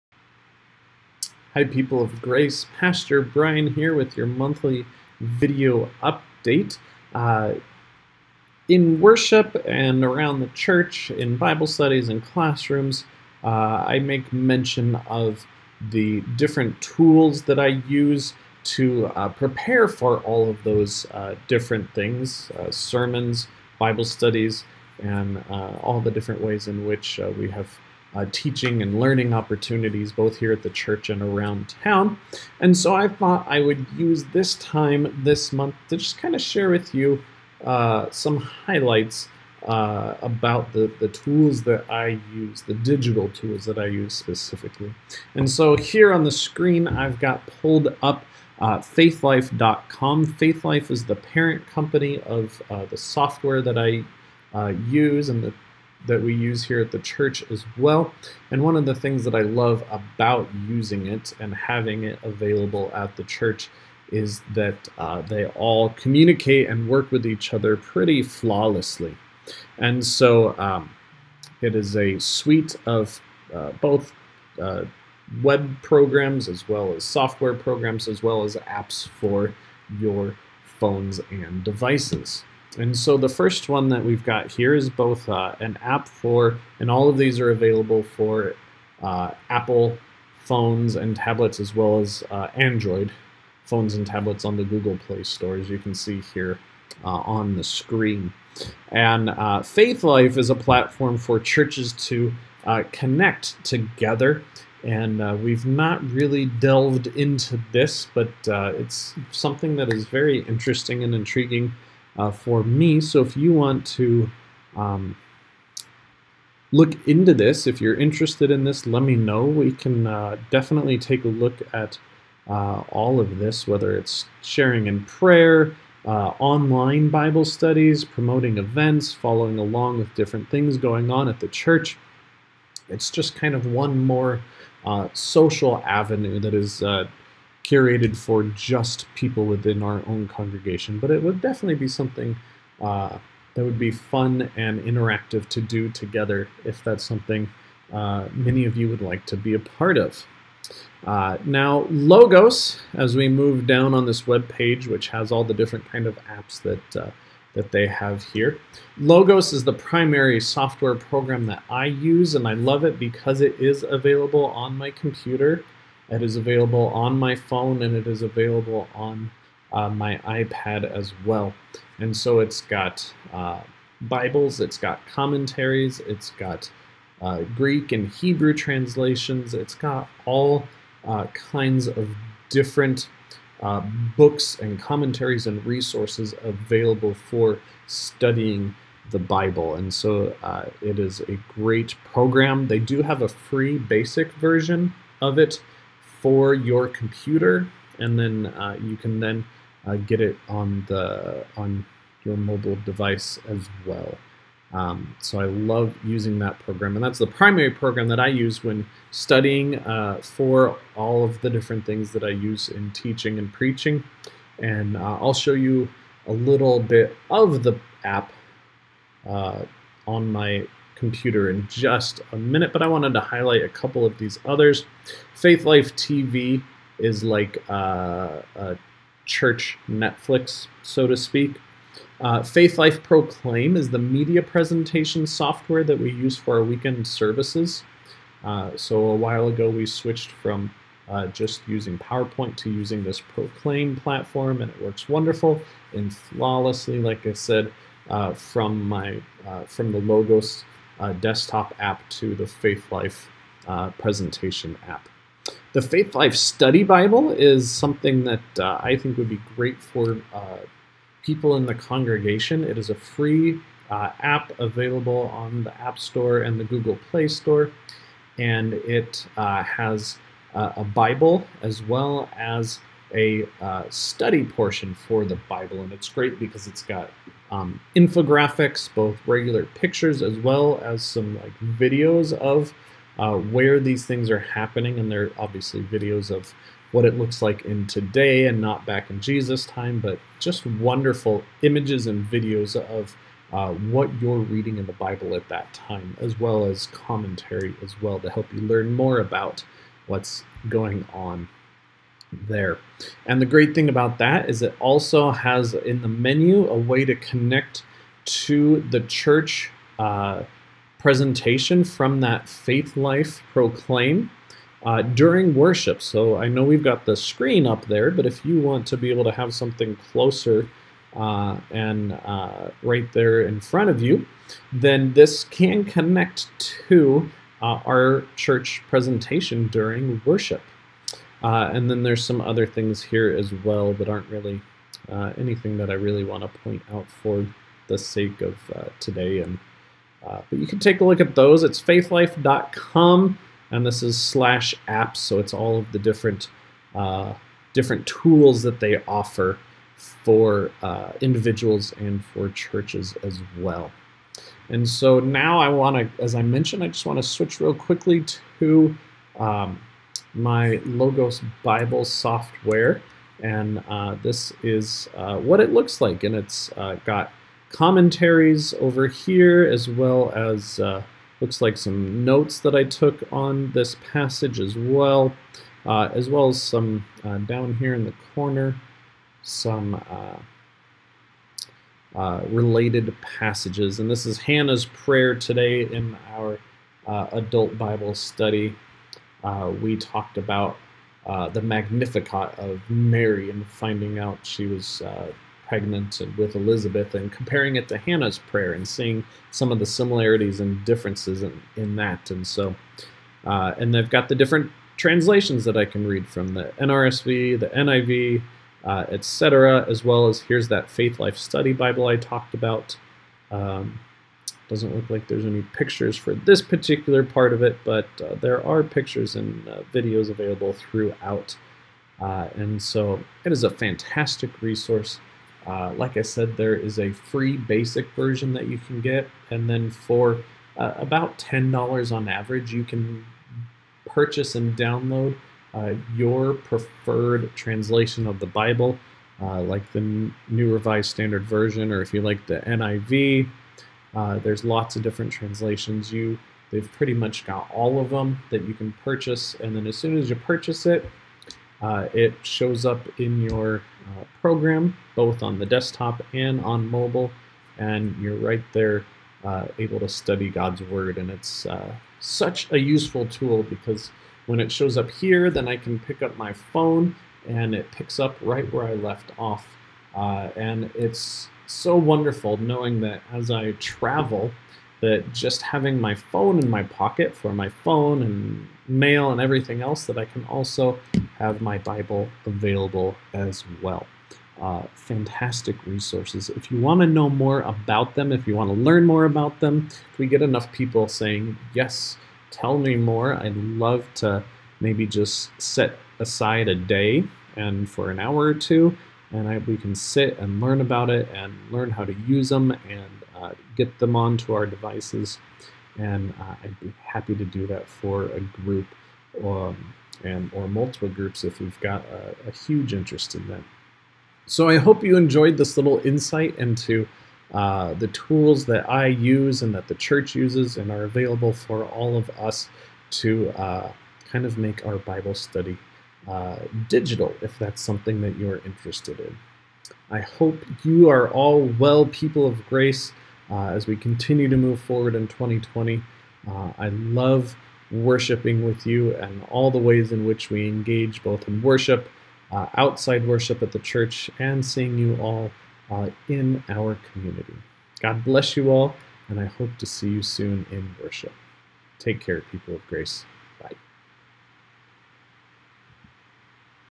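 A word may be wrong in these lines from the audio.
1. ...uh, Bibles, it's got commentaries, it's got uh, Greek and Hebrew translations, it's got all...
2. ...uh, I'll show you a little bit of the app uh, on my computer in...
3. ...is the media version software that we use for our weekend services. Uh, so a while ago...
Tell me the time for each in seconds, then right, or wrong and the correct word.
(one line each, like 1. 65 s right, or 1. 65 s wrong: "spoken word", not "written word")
1. 173 s right
2. 214 s right
3. 233 s wrong: "presentation", not "version".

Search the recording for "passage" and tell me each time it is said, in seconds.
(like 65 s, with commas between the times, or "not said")
374 s, 383 s.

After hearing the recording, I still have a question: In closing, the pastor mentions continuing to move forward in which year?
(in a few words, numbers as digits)
2020.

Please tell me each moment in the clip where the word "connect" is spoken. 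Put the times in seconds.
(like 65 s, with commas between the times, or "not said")
102 s, 307 s, 325 s.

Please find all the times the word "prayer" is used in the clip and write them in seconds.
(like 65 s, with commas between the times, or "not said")
125 s, 384 s, 398 s.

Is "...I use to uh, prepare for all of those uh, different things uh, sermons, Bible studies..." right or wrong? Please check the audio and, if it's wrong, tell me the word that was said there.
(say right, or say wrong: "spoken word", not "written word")
right.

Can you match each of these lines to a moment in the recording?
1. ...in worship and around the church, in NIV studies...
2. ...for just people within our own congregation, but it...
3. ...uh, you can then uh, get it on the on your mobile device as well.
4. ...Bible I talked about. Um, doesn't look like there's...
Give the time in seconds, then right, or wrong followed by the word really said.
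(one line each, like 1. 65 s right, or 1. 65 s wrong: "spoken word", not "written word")
1. 8 s wrong: "Bible", not "NIV"
2. 138 s right
3. 198 s right
4. 411 s right.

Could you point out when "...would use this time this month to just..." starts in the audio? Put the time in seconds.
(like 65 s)
33 s.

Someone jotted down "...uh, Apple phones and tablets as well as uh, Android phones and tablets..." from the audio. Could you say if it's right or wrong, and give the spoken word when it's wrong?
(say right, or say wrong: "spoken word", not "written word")
right.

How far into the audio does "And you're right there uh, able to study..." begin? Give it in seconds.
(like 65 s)
457 s.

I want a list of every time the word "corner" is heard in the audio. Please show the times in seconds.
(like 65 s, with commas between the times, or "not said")
378 s.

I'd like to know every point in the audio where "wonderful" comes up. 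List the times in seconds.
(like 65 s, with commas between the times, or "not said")
245 s, 290 s, 471 s.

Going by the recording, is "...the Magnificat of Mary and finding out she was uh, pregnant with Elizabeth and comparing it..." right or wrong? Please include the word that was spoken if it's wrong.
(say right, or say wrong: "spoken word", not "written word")
right.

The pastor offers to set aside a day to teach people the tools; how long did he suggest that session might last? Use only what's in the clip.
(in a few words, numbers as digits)
an hour or two.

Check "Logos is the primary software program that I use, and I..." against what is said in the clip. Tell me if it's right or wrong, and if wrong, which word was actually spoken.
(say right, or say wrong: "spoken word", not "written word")
right.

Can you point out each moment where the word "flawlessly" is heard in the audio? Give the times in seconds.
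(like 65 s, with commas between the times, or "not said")
68 s, 246 s.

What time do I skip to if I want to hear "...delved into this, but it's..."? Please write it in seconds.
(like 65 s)
106 s.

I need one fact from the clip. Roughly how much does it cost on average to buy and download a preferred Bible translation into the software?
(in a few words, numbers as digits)
$10.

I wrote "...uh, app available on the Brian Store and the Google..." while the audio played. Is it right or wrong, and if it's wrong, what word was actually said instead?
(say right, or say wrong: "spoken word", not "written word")
wrong: "App", not "Brian".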